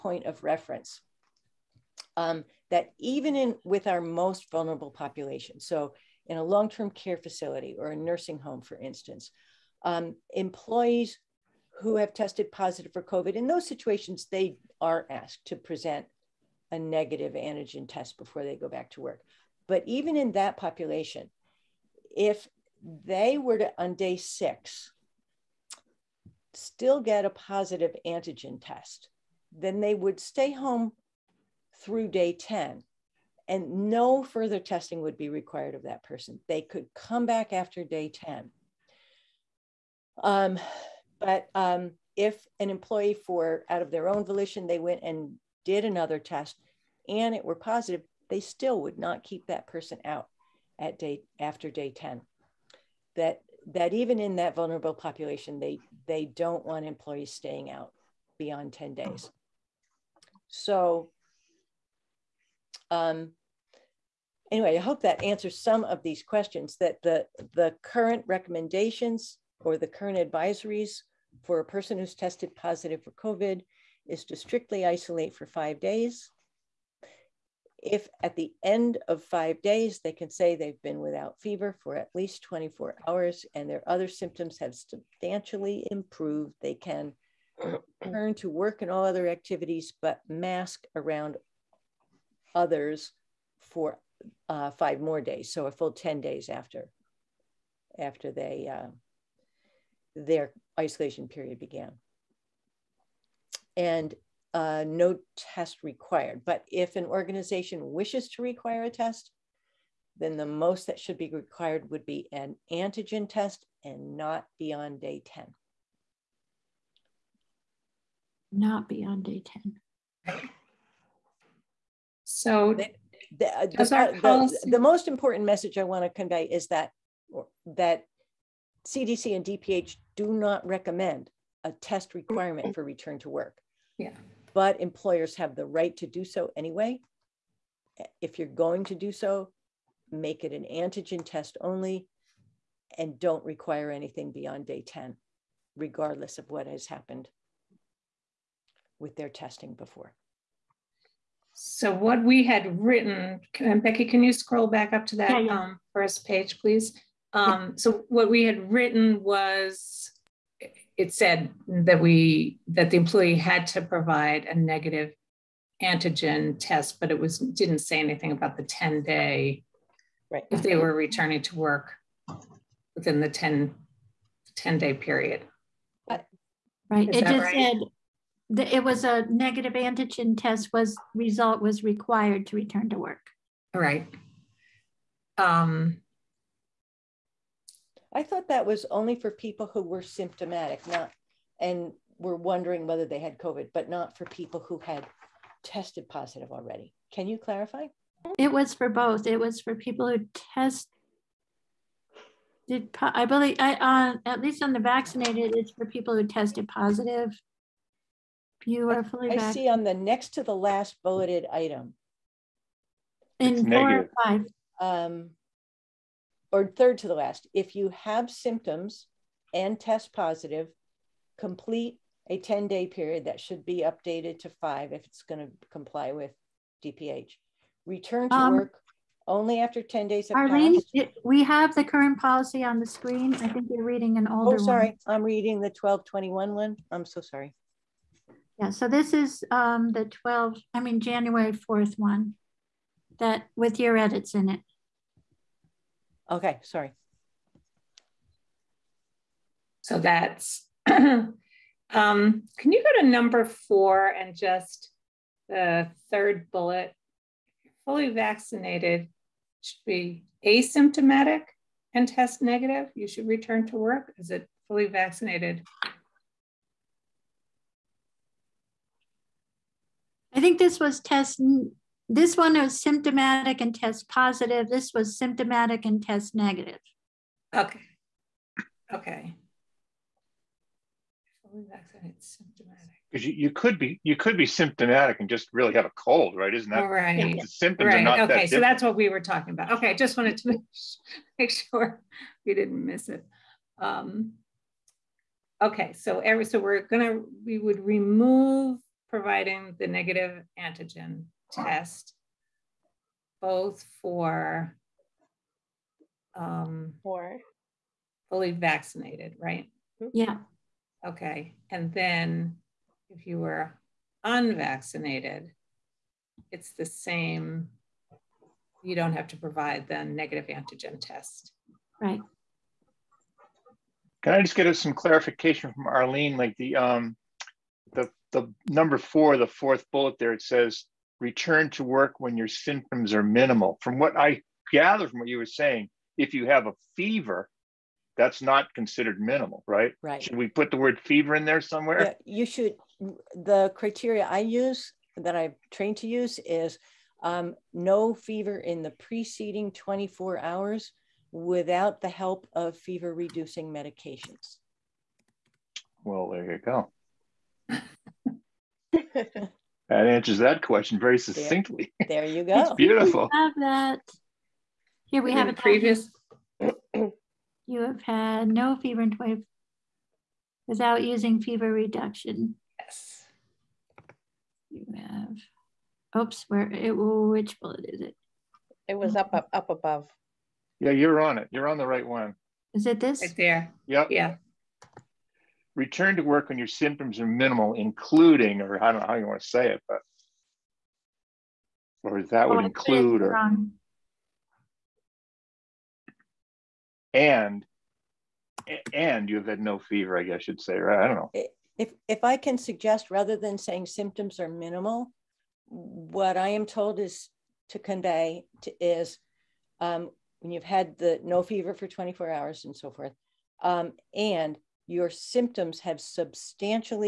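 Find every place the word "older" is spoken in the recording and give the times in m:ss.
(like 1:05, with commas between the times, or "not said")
3:54.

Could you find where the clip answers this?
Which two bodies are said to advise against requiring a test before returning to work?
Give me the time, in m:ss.
2:08.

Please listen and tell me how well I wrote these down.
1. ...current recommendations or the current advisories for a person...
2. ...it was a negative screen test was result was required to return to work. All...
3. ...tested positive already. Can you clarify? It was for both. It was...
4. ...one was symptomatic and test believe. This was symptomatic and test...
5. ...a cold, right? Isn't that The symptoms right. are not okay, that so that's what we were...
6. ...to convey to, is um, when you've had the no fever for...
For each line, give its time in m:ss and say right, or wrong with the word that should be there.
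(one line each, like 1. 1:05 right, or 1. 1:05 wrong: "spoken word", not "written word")
1. 1:07 right
2. 2:58 wrong: "antigen", not "screen"
3. 3:15 right
4. 4:32 wrong: "positive", not "believe"
5. 4:45 right
6. 6:47 right.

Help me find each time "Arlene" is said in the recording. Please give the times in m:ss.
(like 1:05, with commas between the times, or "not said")
3:50, 5:25.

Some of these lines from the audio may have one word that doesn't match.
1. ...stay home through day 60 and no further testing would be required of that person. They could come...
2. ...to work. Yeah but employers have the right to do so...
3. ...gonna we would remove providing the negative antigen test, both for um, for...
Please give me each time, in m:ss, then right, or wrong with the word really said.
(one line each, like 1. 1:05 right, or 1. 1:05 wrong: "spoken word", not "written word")
1. 0:30 wrong: "10", not "60"
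2. 2:13 right
3. 4:56 right.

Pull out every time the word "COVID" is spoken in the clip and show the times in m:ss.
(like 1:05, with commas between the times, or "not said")
0:13, 1:13, 3:13.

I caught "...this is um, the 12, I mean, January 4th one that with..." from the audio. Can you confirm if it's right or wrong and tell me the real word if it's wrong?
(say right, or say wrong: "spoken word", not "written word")
right.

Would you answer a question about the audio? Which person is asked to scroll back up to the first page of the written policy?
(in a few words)
Becky.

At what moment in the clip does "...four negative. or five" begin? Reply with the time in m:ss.
3:33.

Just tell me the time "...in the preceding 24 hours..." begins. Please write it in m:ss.
5:48.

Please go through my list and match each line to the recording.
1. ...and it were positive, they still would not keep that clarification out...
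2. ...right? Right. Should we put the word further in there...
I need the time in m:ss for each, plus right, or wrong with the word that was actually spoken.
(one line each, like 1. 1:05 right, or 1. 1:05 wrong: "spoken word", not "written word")
1. 0:47 wrong: "person", not "clarification"
2. 5:39 wrong: "fever", not "further".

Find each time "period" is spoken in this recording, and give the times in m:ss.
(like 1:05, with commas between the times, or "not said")
1:41, 2:54, 3:42.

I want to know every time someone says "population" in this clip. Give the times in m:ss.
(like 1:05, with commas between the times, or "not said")
0:04, 0:20, 0:54.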